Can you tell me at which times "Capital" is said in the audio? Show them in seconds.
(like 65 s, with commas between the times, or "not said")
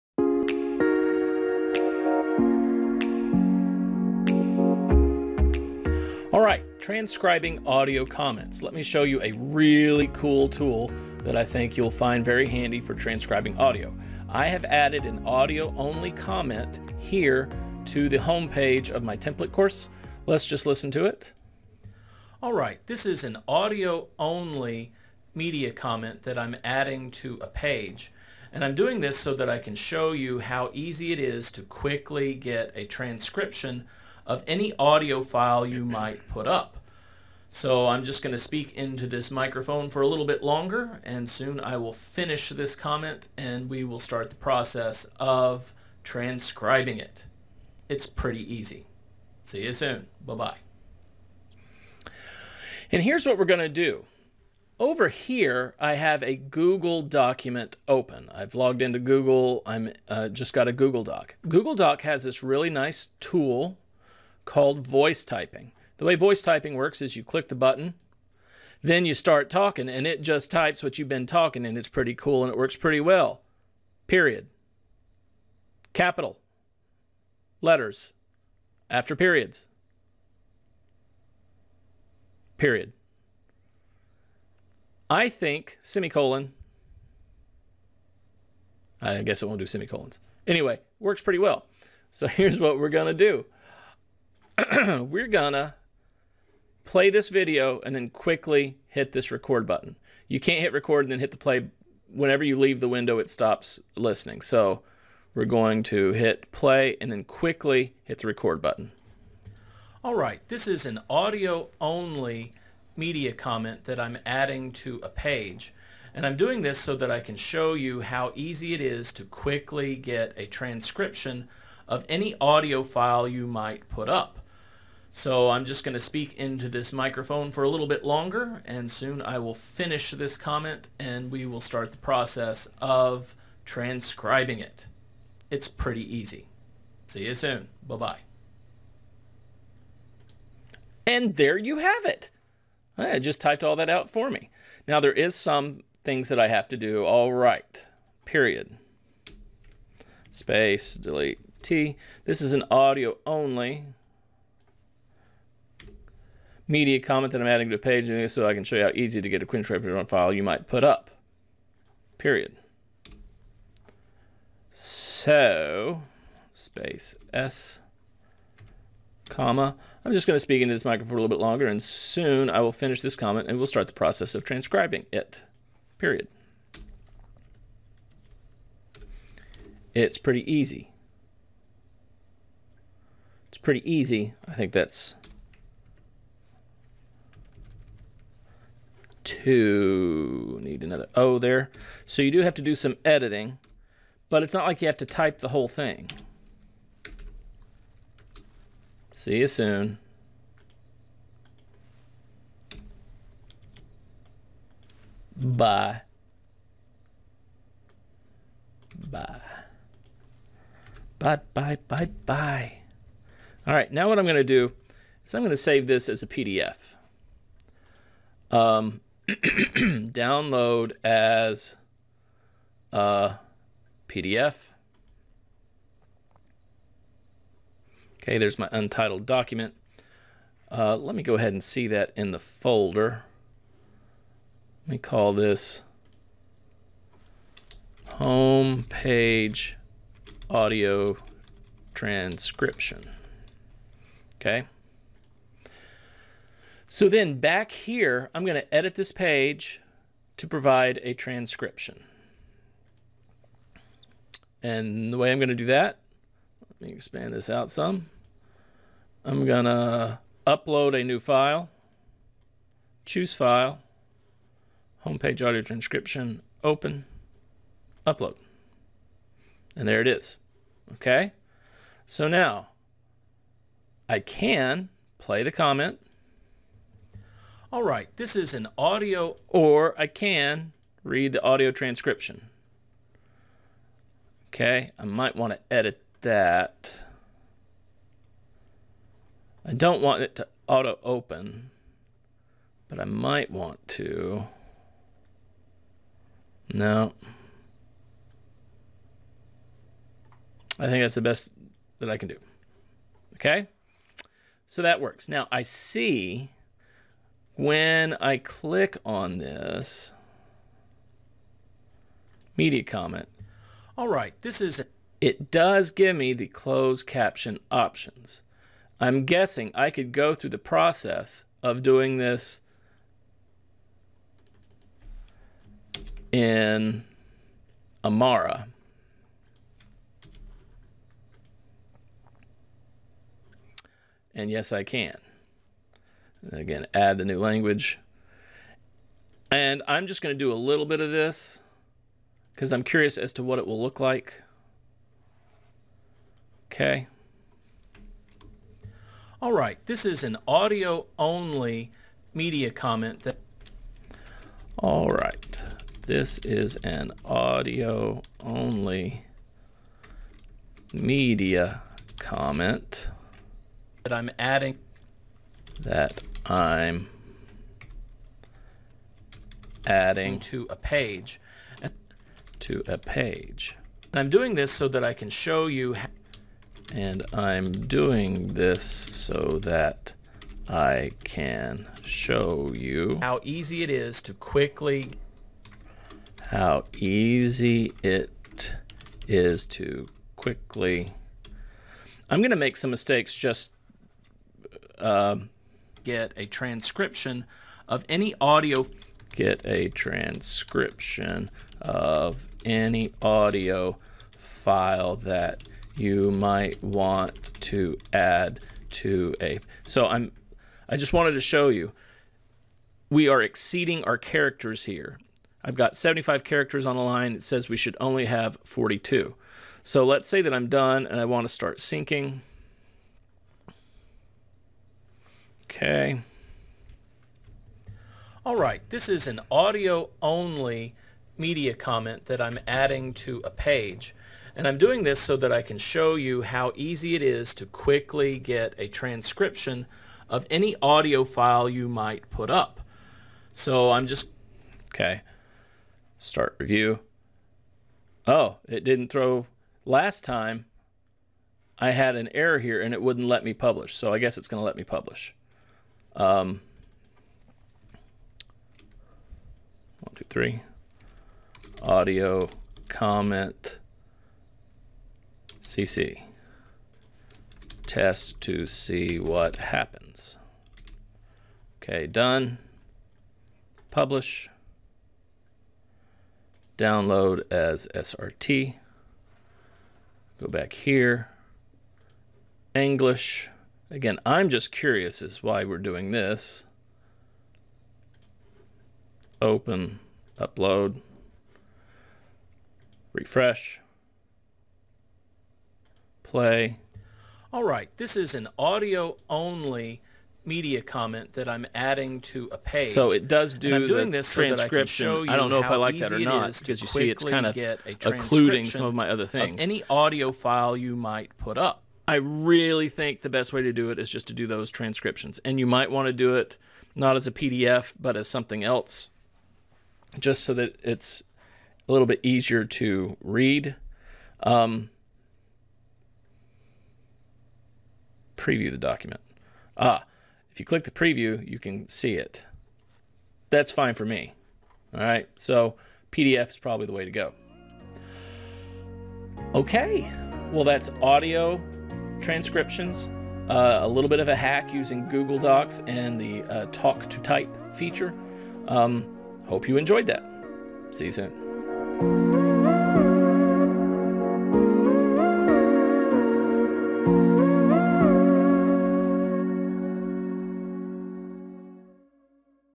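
75 s.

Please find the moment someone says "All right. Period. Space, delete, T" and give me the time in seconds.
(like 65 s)
147 s.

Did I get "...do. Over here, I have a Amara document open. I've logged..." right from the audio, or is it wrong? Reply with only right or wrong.
wrong.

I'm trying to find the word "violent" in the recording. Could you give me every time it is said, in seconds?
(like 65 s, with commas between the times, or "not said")
not said.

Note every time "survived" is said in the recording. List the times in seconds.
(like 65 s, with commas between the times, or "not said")
not said.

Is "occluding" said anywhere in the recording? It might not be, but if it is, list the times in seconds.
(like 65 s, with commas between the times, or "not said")
507 s.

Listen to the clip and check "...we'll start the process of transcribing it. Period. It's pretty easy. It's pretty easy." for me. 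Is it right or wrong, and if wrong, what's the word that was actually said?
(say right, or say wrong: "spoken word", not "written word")
right.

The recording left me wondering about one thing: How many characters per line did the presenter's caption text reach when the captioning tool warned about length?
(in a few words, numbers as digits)
75.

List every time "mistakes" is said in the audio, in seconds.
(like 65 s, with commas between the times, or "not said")
392 s.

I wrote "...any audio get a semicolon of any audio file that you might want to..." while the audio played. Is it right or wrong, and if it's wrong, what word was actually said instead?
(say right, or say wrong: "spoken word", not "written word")
wrong: "transcription", not "semicolon".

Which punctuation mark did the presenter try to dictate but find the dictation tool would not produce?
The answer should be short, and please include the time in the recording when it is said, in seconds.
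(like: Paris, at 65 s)
semicolon, at 85 s.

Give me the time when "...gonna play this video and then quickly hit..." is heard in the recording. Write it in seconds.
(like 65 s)
95 s.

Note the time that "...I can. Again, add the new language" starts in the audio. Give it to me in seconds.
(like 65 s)
334 s.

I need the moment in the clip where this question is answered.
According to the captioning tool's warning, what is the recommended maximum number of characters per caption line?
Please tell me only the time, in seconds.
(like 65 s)
418 s.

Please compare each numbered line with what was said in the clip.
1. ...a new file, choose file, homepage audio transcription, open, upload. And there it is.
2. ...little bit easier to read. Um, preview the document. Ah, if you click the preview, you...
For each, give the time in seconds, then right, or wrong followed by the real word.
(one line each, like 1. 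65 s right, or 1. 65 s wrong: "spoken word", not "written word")
1. 260 s right
2. 521 s right.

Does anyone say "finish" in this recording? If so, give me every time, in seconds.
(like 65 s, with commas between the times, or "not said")
41 s, 129 s, 172 s.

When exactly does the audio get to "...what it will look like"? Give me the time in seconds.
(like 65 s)
343 s.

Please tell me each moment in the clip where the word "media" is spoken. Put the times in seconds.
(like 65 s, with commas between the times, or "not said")
25 s, 112 s, 156 s, 312 s, 352 s, 360 s, 431 s, 500 s.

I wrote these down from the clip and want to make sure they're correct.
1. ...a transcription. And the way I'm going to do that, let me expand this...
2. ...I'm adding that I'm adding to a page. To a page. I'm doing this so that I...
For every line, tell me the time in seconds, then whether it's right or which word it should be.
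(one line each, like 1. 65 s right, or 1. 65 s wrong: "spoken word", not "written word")
1. 251 s right
2. 364 s right.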